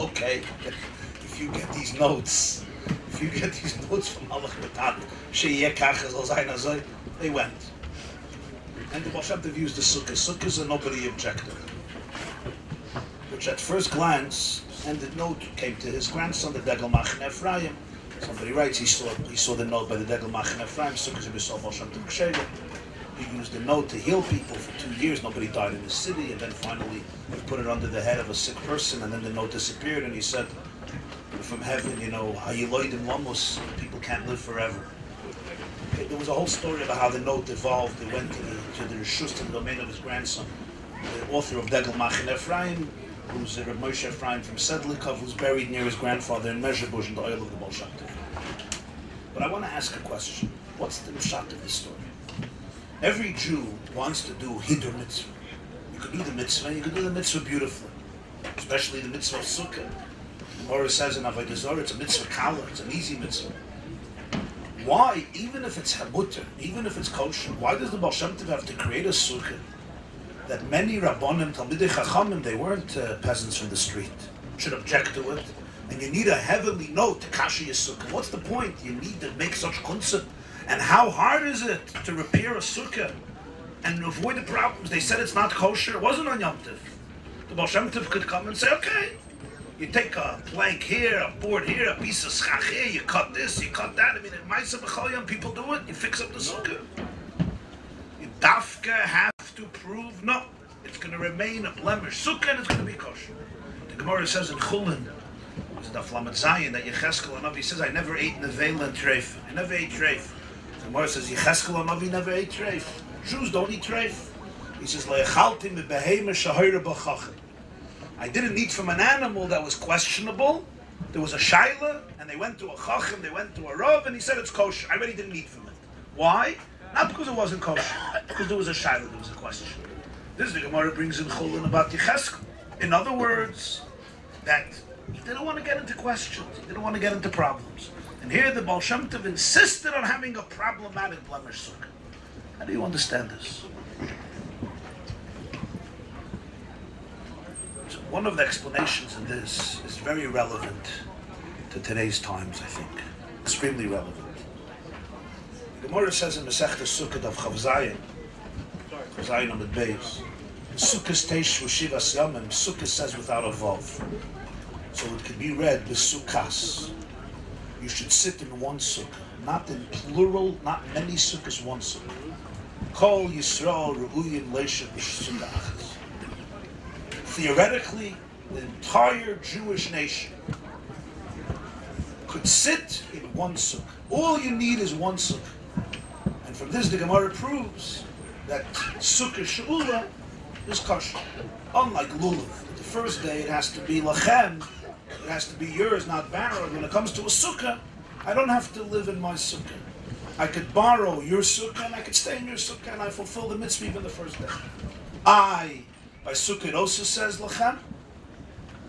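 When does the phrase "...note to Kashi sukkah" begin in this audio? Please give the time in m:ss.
1:16.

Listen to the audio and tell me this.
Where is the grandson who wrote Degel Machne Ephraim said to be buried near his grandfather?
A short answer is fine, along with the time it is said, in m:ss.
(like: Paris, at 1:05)
Mezhebush, at 0:46.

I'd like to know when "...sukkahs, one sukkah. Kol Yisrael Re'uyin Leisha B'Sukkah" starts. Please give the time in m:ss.
2:51.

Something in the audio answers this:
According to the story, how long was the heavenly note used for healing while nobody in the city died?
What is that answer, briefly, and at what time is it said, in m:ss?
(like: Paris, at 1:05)
2 years, at 0:24.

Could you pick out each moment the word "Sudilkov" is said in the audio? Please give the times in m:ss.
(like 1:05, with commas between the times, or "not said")
0:44.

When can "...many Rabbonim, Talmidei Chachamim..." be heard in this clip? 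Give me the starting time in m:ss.
1:10.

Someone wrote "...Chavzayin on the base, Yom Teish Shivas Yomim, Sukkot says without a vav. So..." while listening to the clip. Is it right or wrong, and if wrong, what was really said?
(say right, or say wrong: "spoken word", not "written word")
wrong: "Sukkot", not "Yom".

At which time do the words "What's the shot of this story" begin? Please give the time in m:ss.
0:50.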